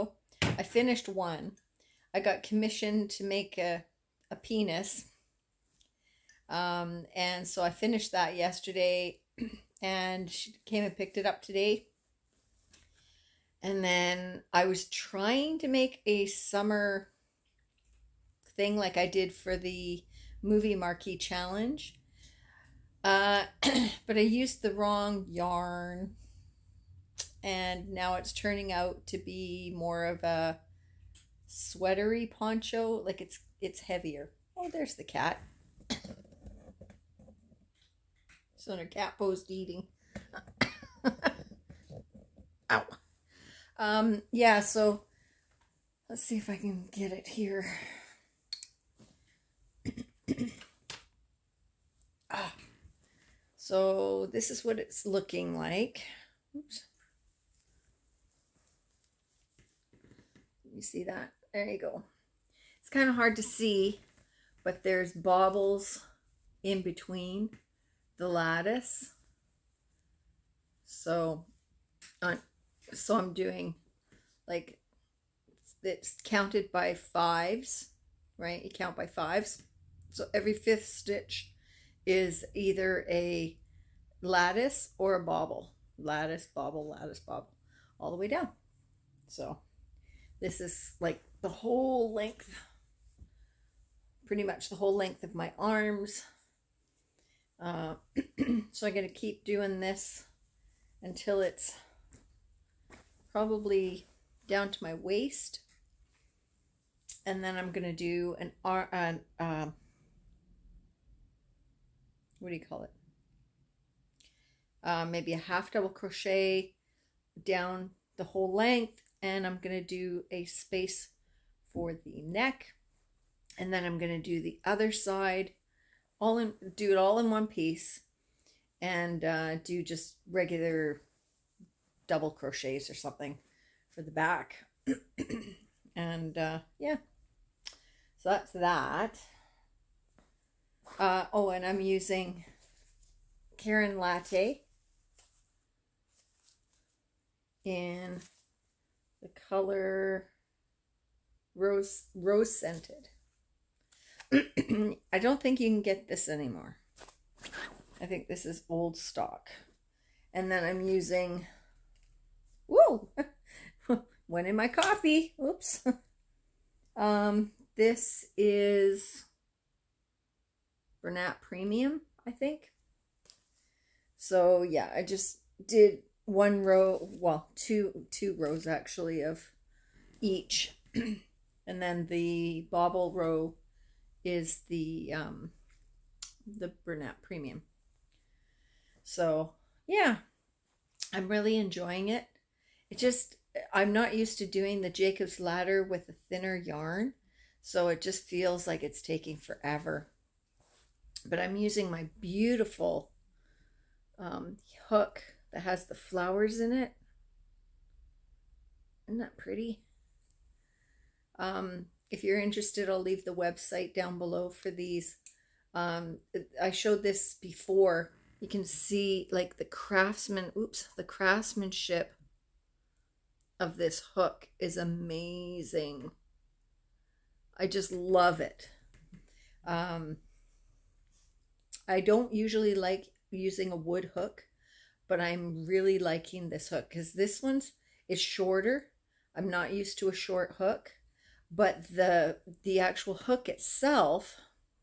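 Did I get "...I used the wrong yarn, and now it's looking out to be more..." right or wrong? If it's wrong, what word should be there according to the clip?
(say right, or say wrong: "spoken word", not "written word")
wrong: "turning", not "looking".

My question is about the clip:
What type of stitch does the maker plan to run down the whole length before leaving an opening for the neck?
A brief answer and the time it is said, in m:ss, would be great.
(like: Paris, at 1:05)
half double crochet, at 1:55.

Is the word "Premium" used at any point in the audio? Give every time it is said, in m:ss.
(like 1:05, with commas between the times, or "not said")
2:51, 3:07.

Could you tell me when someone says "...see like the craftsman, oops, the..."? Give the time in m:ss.
3:38.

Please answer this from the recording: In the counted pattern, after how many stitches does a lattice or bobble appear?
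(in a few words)
5.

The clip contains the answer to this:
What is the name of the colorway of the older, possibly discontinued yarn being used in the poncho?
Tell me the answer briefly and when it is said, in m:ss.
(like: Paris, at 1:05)
rose scented, at 2:31.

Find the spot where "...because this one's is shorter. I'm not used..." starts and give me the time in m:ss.
3:56.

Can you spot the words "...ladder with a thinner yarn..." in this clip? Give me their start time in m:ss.
3:15.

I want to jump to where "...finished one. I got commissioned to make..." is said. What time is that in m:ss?
0:00.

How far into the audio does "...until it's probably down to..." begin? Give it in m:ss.
1:41.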